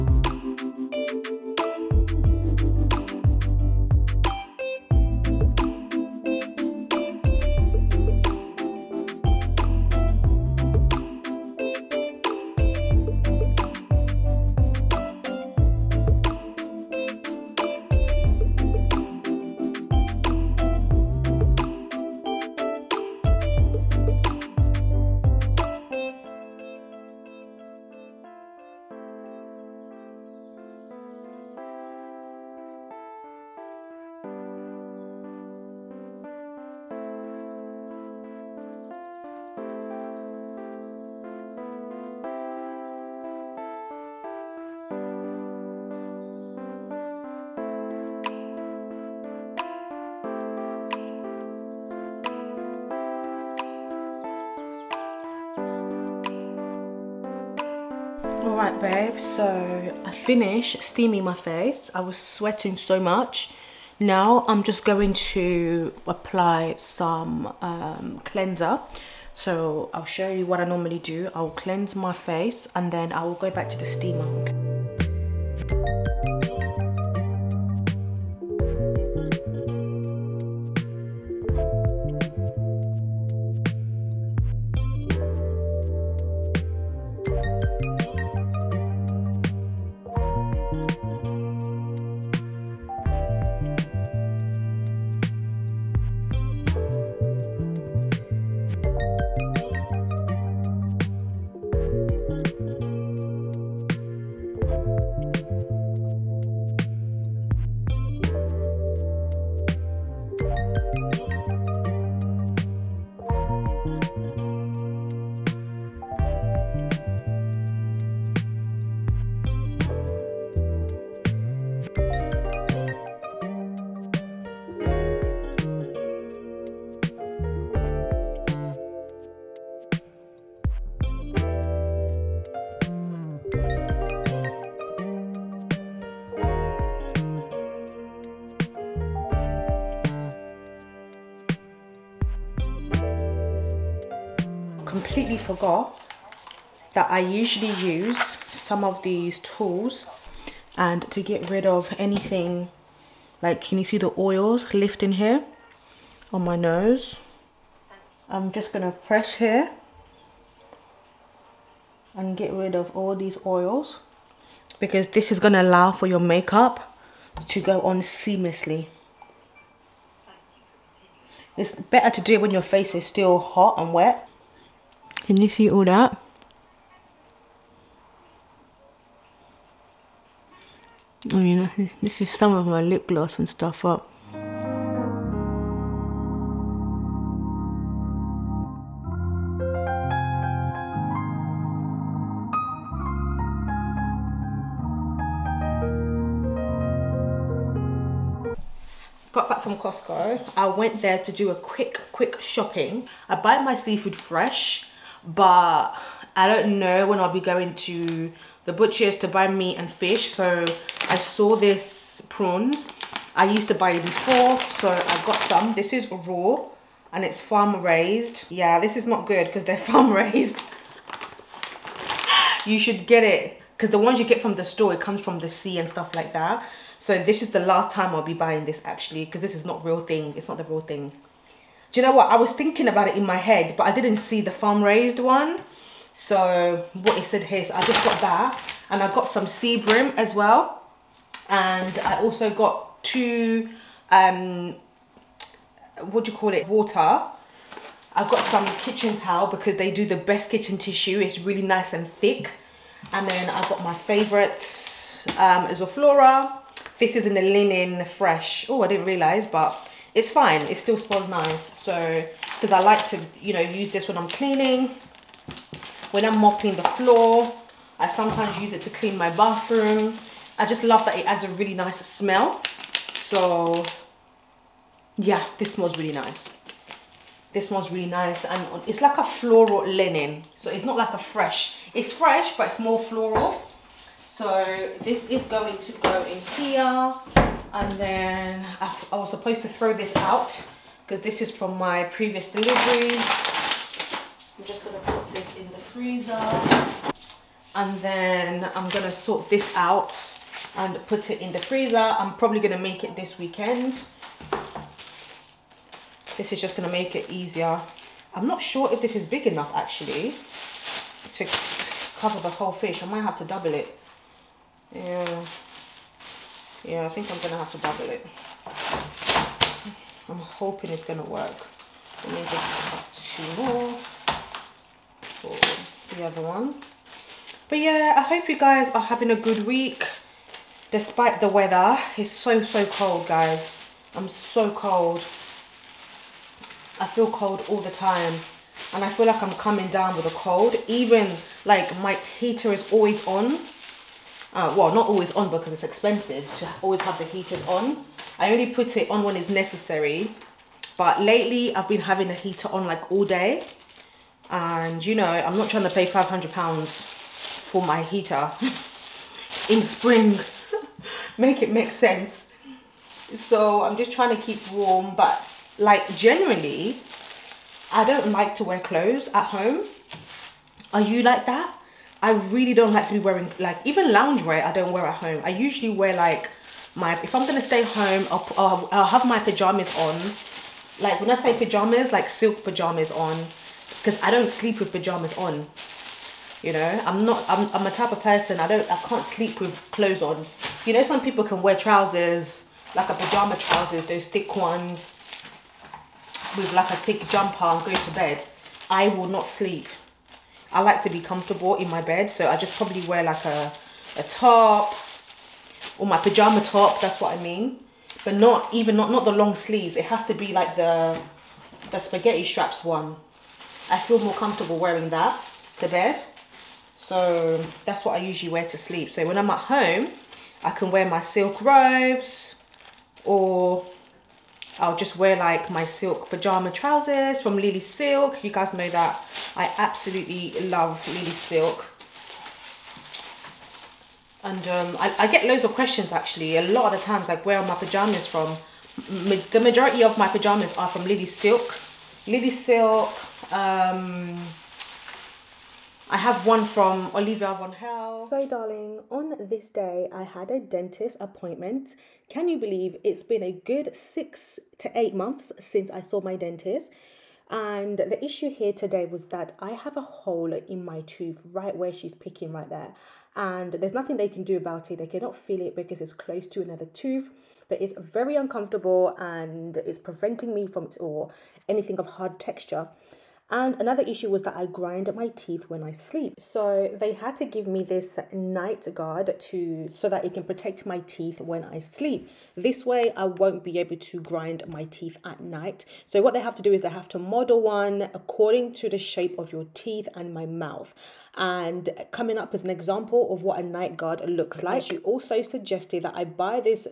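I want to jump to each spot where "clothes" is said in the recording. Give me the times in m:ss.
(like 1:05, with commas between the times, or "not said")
6:08, 6:29.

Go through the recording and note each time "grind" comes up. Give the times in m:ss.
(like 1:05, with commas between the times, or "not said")
7:54, 8:04.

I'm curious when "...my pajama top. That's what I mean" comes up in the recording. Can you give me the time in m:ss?
6:46.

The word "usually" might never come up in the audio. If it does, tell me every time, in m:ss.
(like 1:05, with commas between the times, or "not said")
2:27, 6:15, 6:58.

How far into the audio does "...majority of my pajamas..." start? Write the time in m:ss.
7:19.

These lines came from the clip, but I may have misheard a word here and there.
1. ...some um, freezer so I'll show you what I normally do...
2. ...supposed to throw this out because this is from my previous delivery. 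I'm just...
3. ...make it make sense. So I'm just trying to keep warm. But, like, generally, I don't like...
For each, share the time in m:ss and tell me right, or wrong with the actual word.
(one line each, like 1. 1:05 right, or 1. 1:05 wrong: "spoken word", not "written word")
1. 1:06 wrong: "cleanser", not "freezer"
2. 4:49 right
3. 6:01 right.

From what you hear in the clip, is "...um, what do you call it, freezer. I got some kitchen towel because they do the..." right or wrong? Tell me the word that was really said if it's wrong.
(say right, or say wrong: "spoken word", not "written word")
wrong: "water", not "freezer".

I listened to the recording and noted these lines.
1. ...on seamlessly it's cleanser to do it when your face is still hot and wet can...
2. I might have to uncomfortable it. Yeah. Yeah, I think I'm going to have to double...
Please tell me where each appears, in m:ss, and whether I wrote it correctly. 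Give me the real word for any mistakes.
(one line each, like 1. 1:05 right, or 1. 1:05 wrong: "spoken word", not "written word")
1. 2:47 wrong: "better", not "cleanser"
2. 5:13 wrong: "double", not "uncomfortable".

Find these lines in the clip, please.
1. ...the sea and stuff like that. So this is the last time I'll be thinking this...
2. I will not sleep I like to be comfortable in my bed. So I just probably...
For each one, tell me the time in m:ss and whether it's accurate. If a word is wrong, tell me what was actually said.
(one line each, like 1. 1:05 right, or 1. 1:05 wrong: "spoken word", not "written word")
1. 3:45 wrong: "buying", not "thinking"
2. 6:38 right.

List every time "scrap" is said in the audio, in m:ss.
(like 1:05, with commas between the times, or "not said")
not said.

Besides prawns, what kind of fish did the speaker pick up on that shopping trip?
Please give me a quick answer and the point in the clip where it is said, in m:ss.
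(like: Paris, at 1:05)
Sea bream, at 3:59.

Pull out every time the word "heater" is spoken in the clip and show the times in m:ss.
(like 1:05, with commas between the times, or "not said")
5:42, 5:47, 5:52, 5:58.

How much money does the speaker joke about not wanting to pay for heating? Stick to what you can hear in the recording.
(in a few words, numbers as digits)
£500.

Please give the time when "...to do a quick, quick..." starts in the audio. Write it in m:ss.
3:21.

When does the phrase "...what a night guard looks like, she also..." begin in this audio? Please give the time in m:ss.
8:13.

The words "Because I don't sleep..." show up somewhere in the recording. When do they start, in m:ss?
6:23.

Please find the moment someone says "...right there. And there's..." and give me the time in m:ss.
7:42.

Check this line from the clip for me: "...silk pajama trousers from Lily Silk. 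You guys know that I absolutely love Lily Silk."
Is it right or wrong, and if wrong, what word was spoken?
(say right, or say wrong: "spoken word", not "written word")
right.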